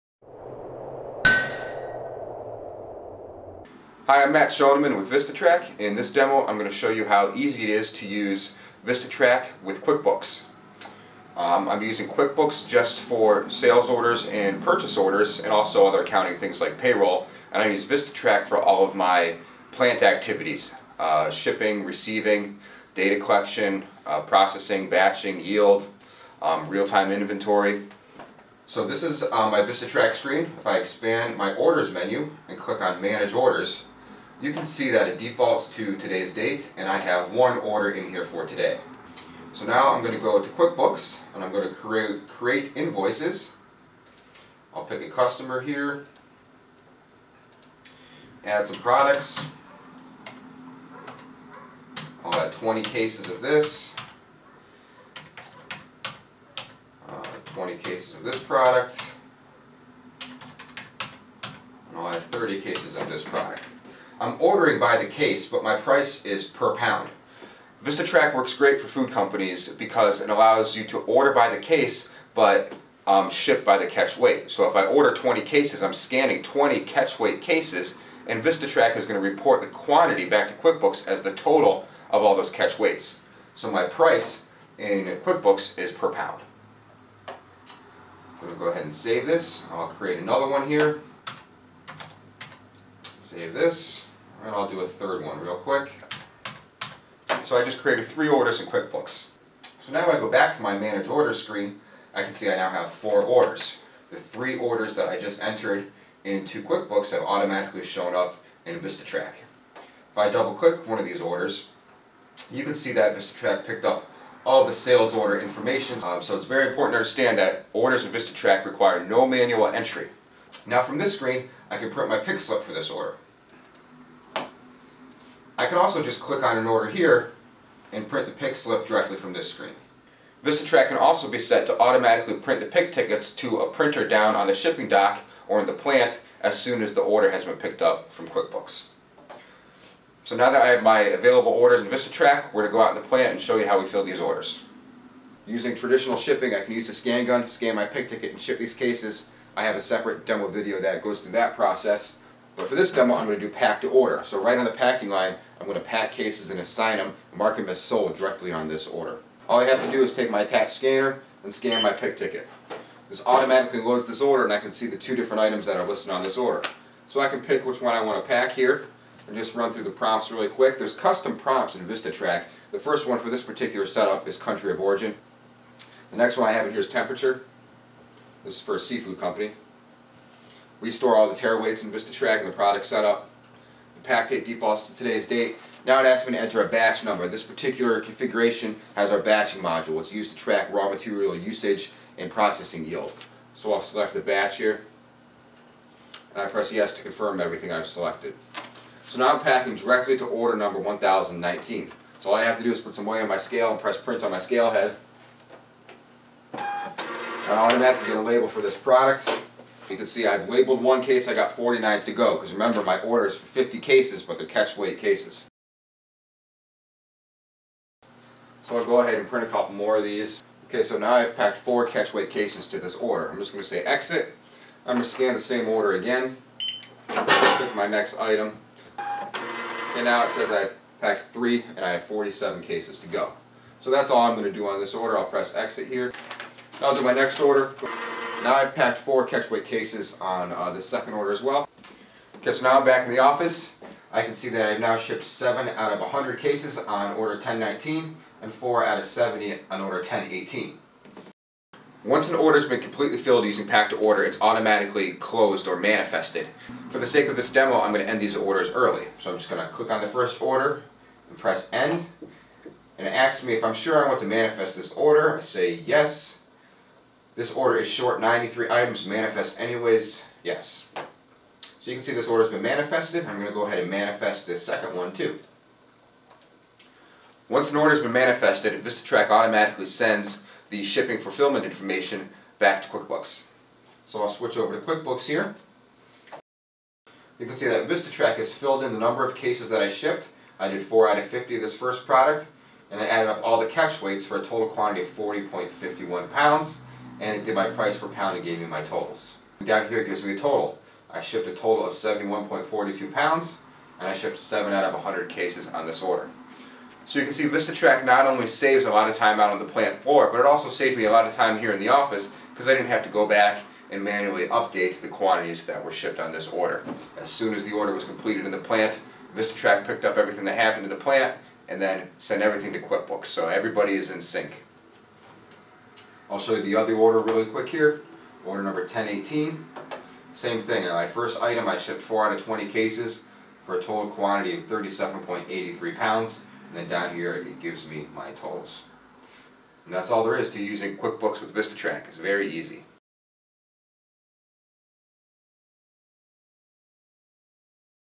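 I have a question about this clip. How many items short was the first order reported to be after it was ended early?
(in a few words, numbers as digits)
93.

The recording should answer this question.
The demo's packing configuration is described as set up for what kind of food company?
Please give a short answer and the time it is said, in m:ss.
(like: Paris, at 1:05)
seafood company, at 2:58.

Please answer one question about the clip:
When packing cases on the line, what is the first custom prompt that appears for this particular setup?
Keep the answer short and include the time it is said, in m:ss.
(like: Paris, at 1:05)
country of origin, at 2:54.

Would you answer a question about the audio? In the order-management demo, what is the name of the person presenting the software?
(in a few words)
Matt Shoneman.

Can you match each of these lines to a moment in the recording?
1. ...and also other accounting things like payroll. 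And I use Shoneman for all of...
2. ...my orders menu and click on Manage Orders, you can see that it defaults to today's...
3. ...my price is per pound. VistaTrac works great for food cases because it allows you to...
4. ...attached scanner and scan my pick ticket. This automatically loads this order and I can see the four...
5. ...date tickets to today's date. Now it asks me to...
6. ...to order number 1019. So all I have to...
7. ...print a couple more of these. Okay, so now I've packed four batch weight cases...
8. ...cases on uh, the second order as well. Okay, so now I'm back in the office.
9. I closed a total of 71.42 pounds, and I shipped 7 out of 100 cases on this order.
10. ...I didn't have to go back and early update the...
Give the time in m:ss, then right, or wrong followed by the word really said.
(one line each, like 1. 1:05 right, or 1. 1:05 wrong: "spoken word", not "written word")
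1. 0:15 wrong: "VistaTrac", not "Shoneman"
2. 0:31 right
3. 1:05 wrong: "companies", not "cases"
4. 2:40 wrong: "two", not "four"
5. 3:04 wrong: "defaults", not "tickets"
6. 3:20 right
7. 3:39 wrong: "catch", not "batch"
8. 3:59 right
9. 5:01 wrong: "shipped", not "closed"
10. 5:12 wrong: "manually", not "early".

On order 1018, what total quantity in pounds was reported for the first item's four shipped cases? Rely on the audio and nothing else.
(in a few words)
37.83 pounds.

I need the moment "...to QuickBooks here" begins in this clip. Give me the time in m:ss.
4:44.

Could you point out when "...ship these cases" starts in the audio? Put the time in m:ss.
2:28.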